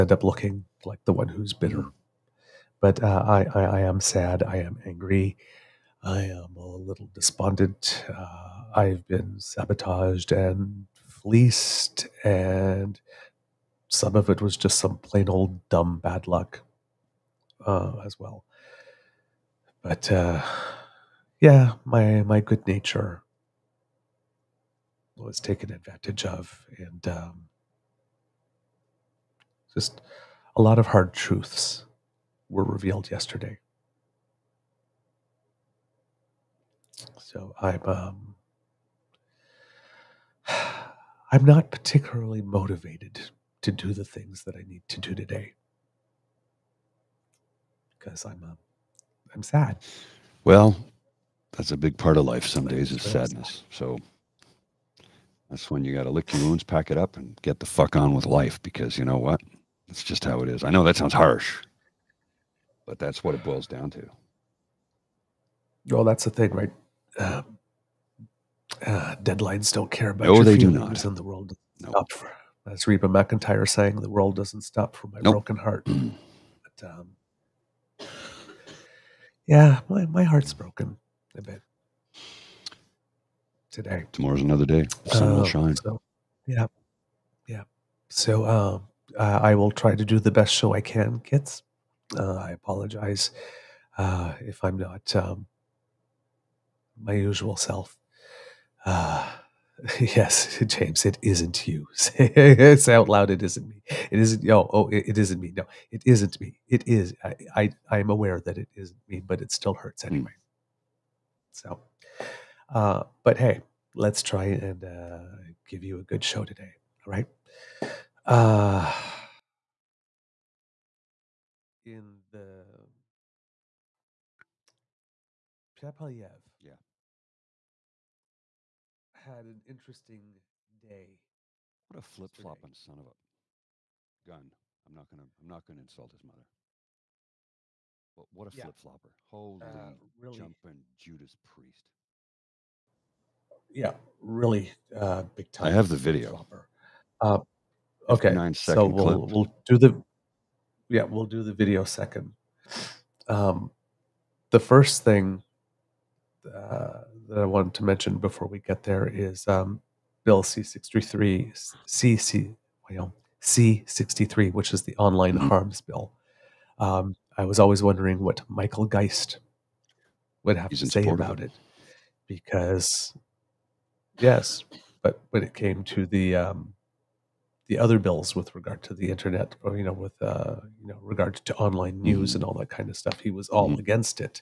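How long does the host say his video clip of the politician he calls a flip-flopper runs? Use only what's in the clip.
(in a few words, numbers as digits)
9 seconds.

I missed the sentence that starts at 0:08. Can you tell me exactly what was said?
Uh, I've been sabotaged and fleeced, and some of it was just some plain old dumb bad luck uh, as well.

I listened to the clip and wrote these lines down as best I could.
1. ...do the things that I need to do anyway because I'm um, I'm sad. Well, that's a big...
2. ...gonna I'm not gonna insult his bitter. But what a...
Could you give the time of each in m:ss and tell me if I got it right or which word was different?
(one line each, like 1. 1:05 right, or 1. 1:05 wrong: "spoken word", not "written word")
1. 0:43 wrong: "today", not "anyway"
2. 2:15 wrong: "mother", not "bitter".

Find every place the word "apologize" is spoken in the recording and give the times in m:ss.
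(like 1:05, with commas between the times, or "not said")
1:32.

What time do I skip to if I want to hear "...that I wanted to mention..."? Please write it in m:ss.
2:37.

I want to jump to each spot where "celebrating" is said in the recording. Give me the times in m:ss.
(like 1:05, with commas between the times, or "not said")
not said.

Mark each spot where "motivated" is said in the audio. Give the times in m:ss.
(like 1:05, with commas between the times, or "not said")
0:42.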